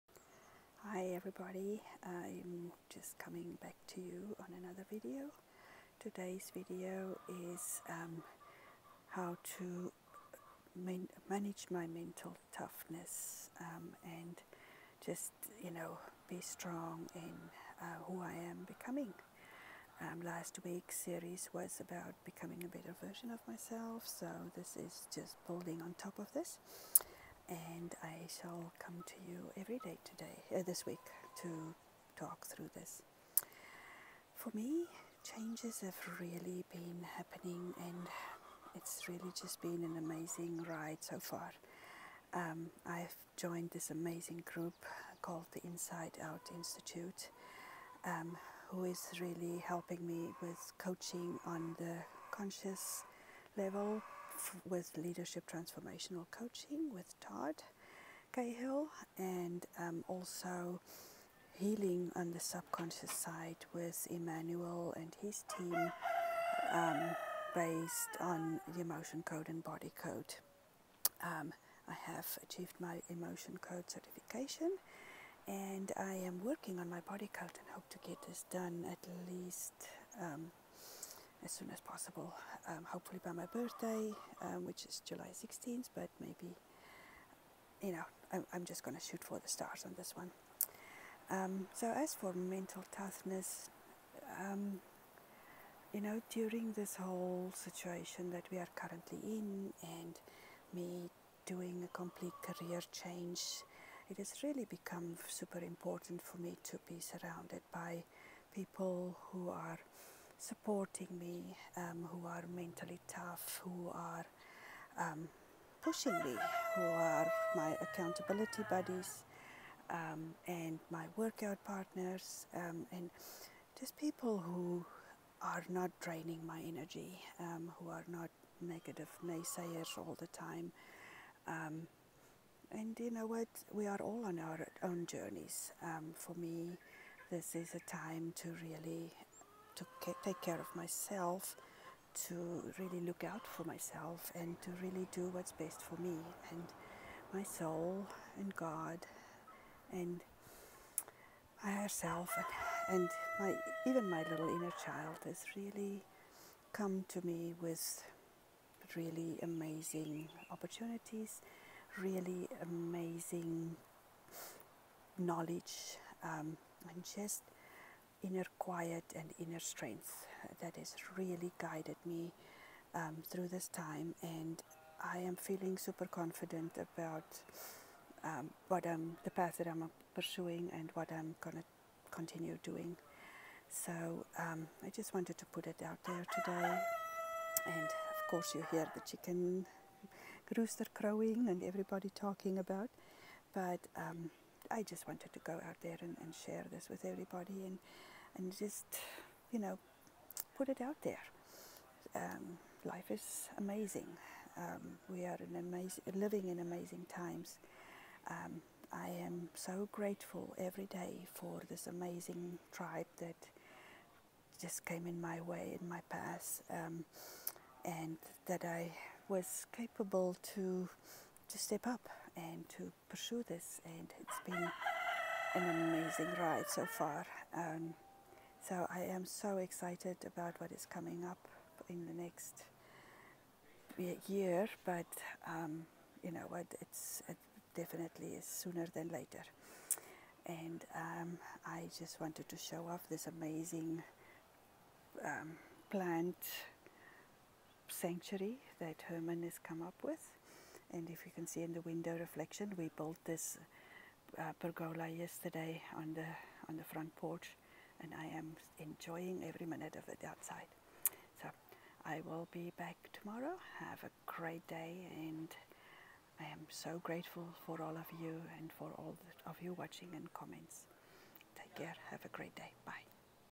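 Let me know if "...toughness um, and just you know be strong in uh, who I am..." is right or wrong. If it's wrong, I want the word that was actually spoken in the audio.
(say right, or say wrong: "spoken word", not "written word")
right.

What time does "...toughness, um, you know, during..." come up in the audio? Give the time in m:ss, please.
1:32.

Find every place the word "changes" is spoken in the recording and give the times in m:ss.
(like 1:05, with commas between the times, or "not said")
0:35, 1:42.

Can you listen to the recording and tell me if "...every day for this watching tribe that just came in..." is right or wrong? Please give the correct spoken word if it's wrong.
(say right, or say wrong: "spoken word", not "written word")
wrong: "amazing", not "watching".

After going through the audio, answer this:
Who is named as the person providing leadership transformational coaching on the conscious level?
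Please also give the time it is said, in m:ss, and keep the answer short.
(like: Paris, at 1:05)
Todd Cahill, at 0:57.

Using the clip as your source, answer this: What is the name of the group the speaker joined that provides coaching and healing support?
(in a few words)
Inside Out Institute.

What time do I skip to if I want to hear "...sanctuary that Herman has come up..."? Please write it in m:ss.
4:07.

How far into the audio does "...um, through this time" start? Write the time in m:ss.
2:52.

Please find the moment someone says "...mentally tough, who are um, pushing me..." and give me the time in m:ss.
1:52.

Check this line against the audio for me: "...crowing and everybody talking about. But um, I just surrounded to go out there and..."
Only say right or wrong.
wrong.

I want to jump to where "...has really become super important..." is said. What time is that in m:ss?
1:44.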